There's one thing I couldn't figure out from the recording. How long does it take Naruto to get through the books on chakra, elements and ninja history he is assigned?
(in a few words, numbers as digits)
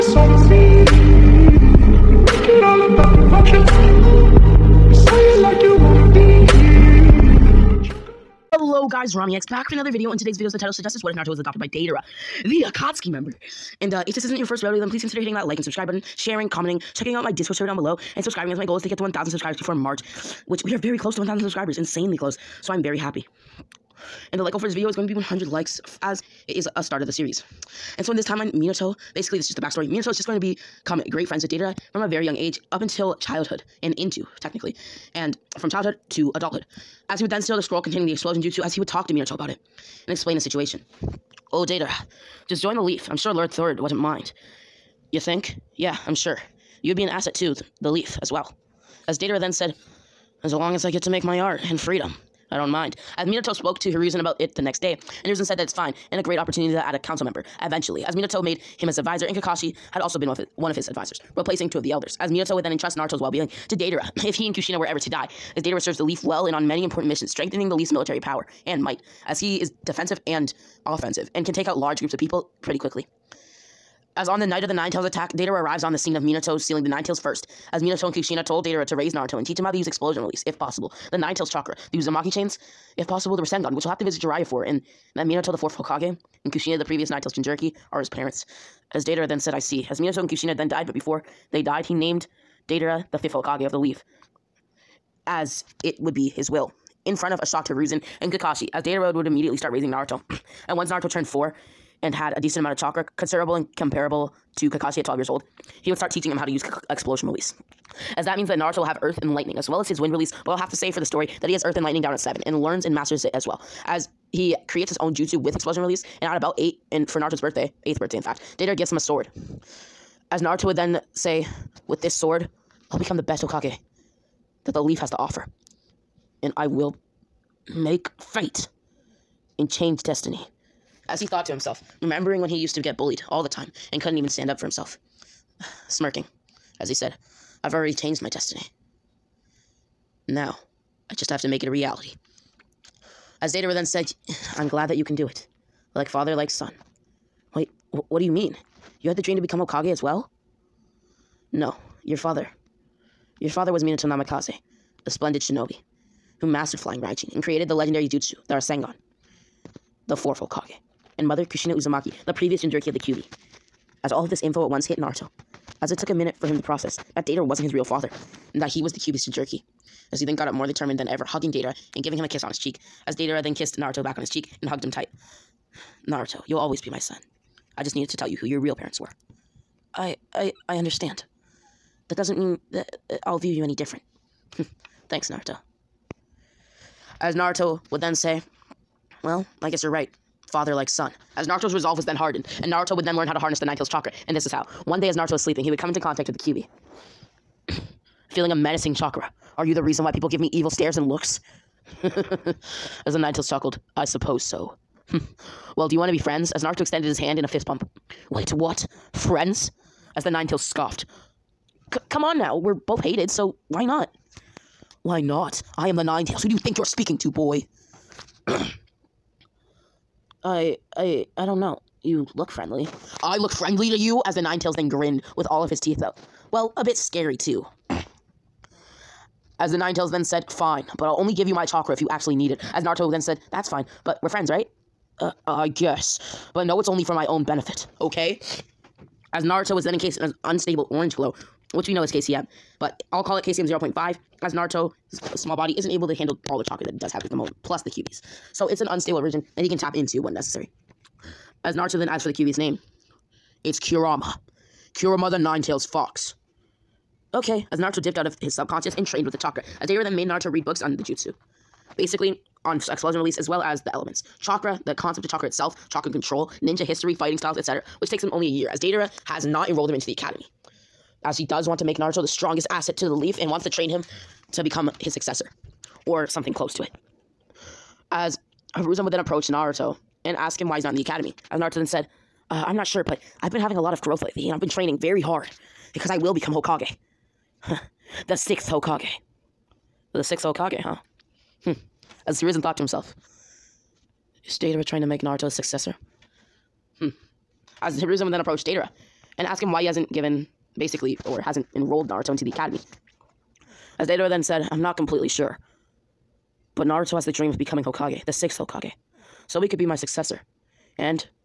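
A year.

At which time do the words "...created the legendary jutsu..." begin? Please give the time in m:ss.
2:37.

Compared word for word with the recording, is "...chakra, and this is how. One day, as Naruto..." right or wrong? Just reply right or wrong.
right.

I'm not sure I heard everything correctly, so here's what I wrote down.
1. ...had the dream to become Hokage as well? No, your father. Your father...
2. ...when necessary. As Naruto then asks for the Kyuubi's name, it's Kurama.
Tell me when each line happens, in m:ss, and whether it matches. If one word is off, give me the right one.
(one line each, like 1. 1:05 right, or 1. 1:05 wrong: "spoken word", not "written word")
1. 2:29 right
2. 4:10 right.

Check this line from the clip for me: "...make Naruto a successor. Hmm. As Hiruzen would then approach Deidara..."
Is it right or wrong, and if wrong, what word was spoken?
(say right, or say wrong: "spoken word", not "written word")
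right.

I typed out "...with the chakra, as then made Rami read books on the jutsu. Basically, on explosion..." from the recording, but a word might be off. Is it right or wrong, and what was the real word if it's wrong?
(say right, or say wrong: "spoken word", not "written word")
wrong: "Naruto", not "Rami".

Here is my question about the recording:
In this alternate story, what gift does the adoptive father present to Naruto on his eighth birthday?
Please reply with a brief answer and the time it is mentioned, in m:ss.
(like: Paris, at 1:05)
A sword, at 1:58.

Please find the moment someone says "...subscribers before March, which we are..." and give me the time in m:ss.
0:19.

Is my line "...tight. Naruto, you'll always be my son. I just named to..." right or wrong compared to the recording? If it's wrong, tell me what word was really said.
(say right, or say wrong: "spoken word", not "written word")
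wrong: "needed", not "named".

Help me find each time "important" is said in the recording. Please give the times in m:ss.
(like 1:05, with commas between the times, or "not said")
1:06.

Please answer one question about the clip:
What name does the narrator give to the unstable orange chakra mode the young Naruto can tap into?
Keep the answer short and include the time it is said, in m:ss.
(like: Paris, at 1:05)
KCM 0.5, at 4:03.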